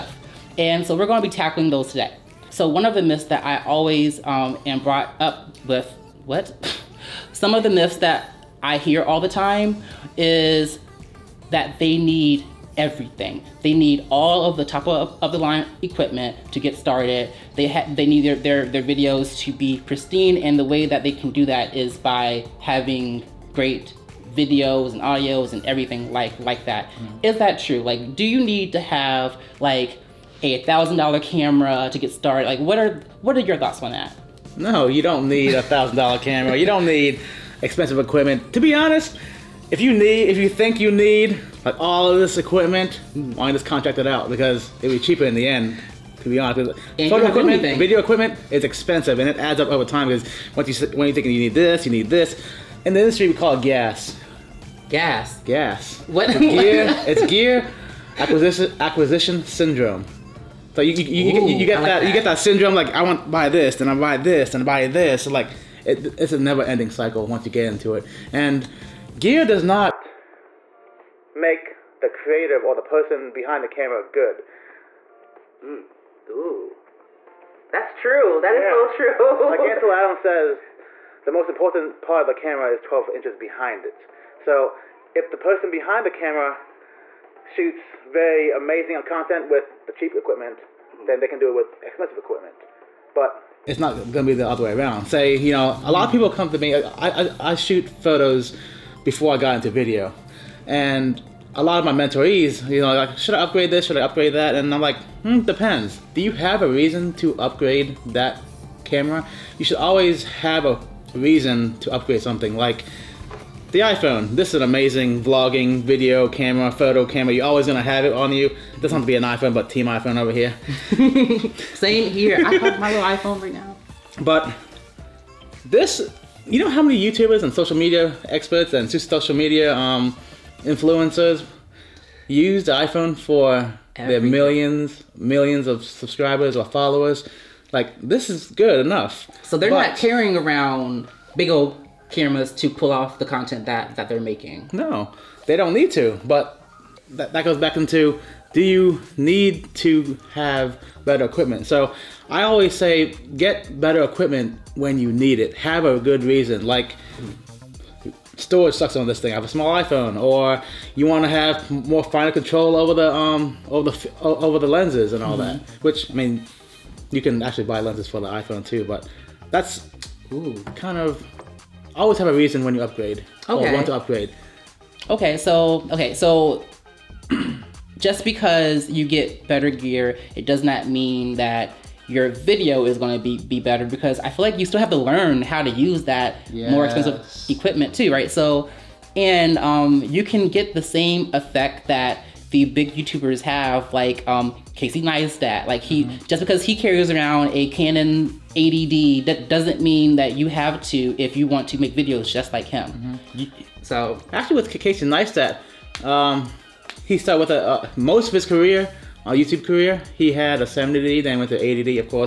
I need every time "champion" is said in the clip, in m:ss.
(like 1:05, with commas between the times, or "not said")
not said.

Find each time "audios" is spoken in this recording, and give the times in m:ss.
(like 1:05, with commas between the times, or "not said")
0:25.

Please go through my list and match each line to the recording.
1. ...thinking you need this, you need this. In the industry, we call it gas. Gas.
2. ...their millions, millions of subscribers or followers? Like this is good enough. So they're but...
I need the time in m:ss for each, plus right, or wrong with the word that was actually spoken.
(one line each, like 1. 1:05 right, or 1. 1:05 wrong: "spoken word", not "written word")
1. 0:51 right
2. 2:13 right.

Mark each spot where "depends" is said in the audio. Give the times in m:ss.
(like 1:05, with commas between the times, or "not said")
1:45.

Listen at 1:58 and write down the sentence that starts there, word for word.
It doesn't have to be an iPhone, but team iPhone over here.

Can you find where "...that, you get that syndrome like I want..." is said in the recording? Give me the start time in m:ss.
1:01.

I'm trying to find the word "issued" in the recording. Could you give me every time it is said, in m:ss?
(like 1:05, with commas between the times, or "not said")
not said.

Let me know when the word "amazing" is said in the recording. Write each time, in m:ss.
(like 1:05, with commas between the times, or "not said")
1:28, 1:54.